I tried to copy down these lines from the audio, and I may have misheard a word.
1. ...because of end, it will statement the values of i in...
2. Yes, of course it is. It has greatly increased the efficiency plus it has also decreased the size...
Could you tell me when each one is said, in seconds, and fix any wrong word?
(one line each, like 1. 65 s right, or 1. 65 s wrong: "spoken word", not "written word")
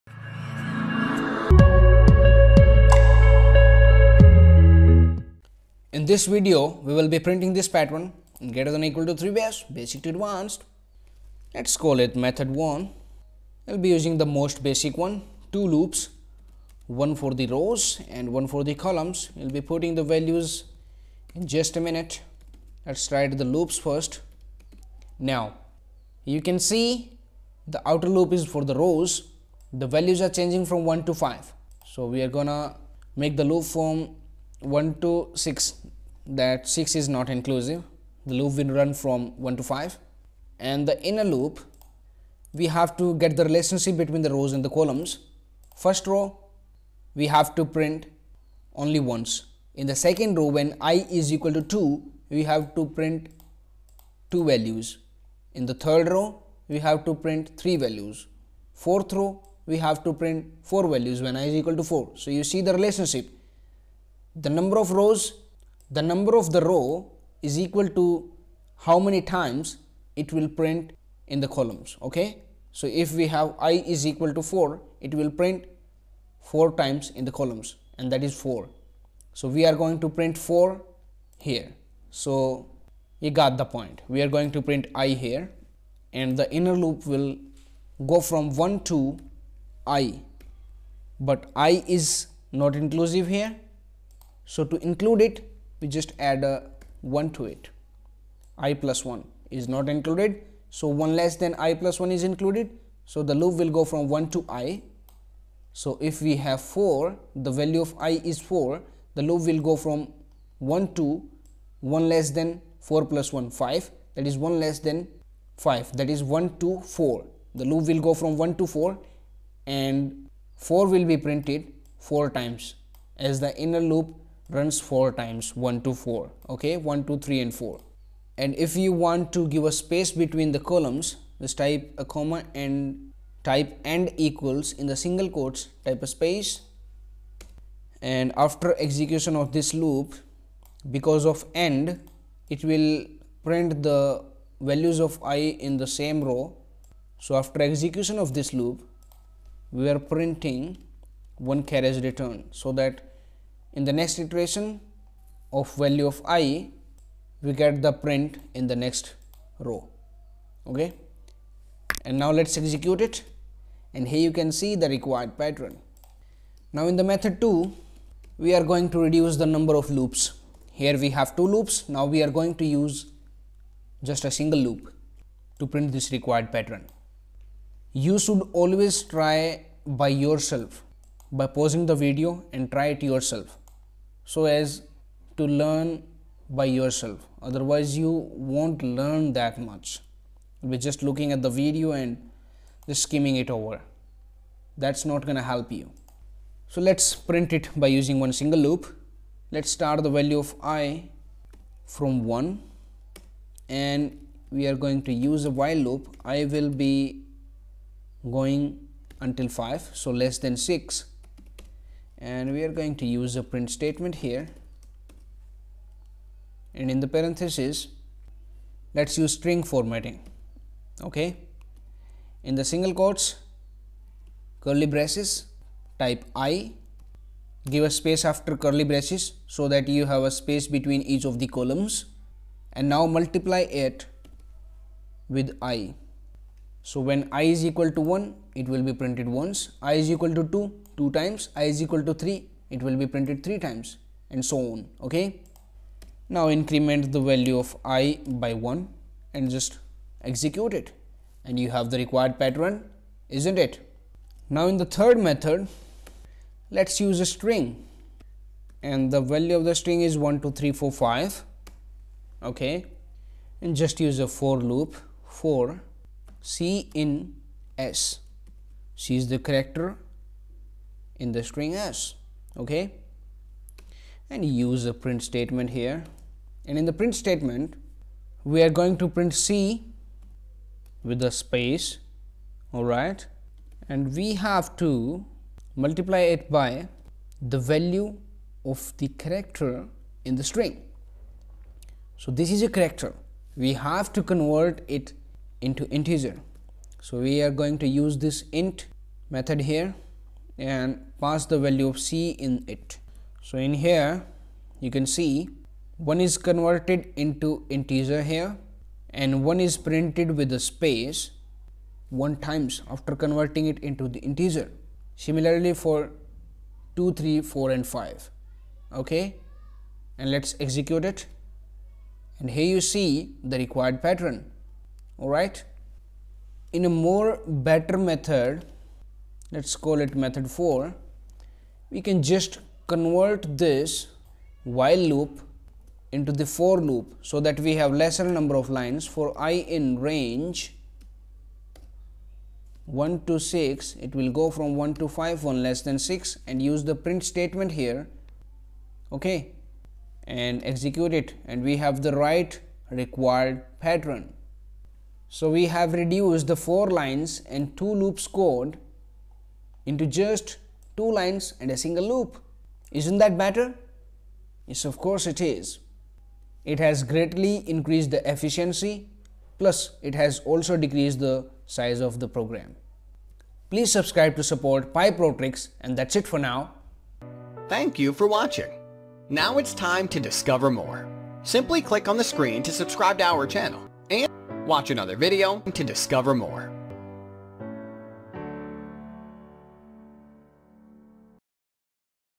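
1. 140 s wrong: "print", not "statement"
2. 364 s right.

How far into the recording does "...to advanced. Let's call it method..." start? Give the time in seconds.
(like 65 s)
10 s.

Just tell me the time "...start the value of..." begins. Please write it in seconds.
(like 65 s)
199 s.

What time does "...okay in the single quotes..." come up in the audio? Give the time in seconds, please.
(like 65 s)
221 s.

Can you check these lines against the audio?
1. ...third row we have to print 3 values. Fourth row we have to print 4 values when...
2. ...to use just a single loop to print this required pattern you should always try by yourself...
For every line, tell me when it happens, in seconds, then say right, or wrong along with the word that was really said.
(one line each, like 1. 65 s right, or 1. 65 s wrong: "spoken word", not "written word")
1. 55 s right
2. 172 s right.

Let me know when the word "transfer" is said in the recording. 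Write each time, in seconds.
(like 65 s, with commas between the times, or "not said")
not said.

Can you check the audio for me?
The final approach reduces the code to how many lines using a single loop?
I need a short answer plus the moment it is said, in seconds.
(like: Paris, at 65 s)
2, at 360 s.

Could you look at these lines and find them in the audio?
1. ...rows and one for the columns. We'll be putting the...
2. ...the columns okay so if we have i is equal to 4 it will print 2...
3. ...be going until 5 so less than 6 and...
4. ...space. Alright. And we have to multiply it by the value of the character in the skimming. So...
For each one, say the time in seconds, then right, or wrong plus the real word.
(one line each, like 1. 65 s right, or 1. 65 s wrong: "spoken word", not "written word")
1. 17 s right
2. 71 s wrong: "4", not "2"
3. 206 s right
4. 281 s wrong: "string", not "skimming".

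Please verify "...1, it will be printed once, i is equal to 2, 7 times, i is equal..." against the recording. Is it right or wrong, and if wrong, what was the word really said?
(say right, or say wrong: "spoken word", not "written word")
wrong: "2", not "7".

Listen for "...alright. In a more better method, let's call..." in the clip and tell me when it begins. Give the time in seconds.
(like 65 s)
325 s.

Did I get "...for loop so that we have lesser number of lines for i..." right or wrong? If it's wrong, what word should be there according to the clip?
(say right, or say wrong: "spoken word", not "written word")
right.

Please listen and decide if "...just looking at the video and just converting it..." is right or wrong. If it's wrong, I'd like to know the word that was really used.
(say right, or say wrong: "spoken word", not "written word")
wrong: "skimming", not "converting".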